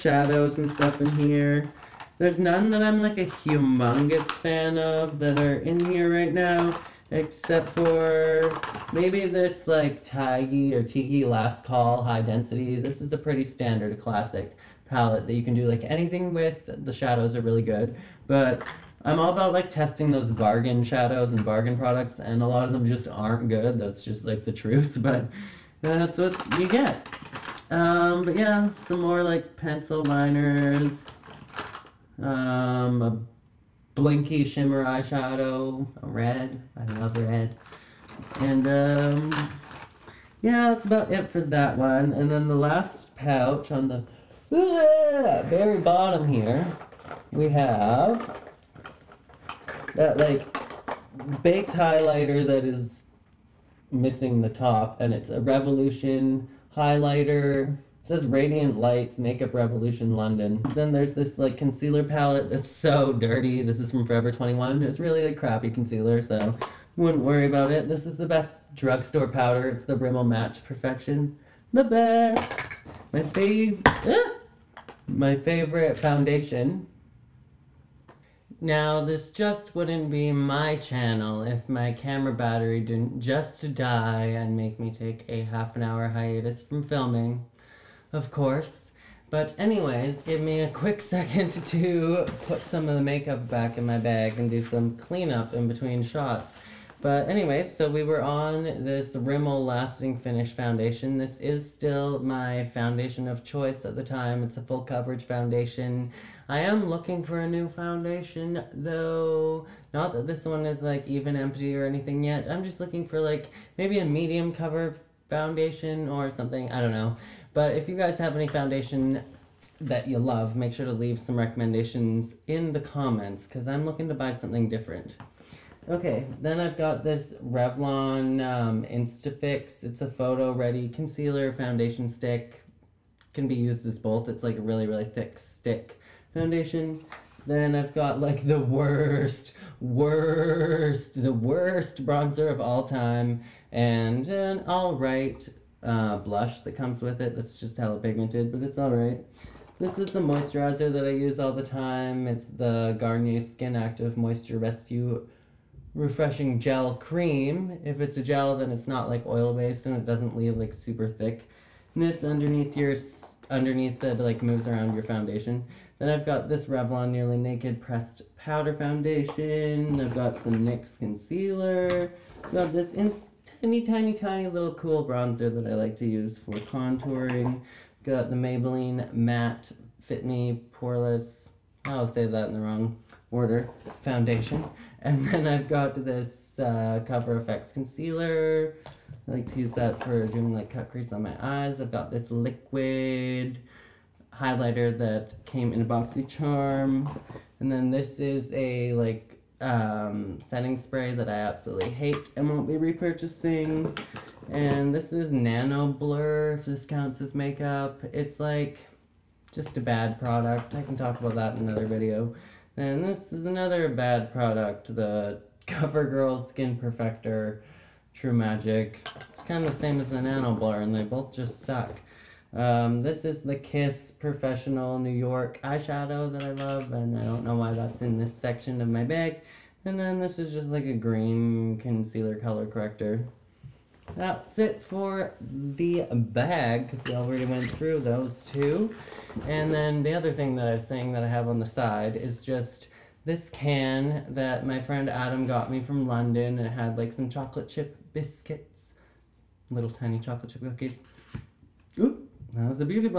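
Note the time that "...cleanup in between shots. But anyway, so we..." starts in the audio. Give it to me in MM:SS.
01:34.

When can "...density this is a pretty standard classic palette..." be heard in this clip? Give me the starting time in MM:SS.
00:12.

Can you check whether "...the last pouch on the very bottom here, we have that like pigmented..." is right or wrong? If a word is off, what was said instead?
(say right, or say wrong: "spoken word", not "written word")
wrong: "baked", not "pigmented".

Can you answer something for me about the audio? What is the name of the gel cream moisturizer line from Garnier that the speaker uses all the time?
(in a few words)
Skin Active Moisture Rescue.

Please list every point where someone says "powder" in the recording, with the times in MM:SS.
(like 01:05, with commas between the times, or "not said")
01:09, 02:48.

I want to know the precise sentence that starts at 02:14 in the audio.
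It's like a really, really thick stick foundation.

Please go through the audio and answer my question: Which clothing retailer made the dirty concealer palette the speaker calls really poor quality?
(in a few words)
Forever 21.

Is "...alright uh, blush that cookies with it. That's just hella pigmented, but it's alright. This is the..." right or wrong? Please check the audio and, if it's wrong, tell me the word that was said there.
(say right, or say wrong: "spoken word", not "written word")
wrong: "comes", not "cookies".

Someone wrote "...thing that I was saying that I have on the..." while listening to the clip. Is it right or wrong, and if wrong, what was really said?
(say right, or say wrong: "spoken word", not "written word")
right.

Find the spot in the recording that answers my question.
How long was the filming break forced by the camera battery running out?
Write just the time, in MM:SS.
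01:25.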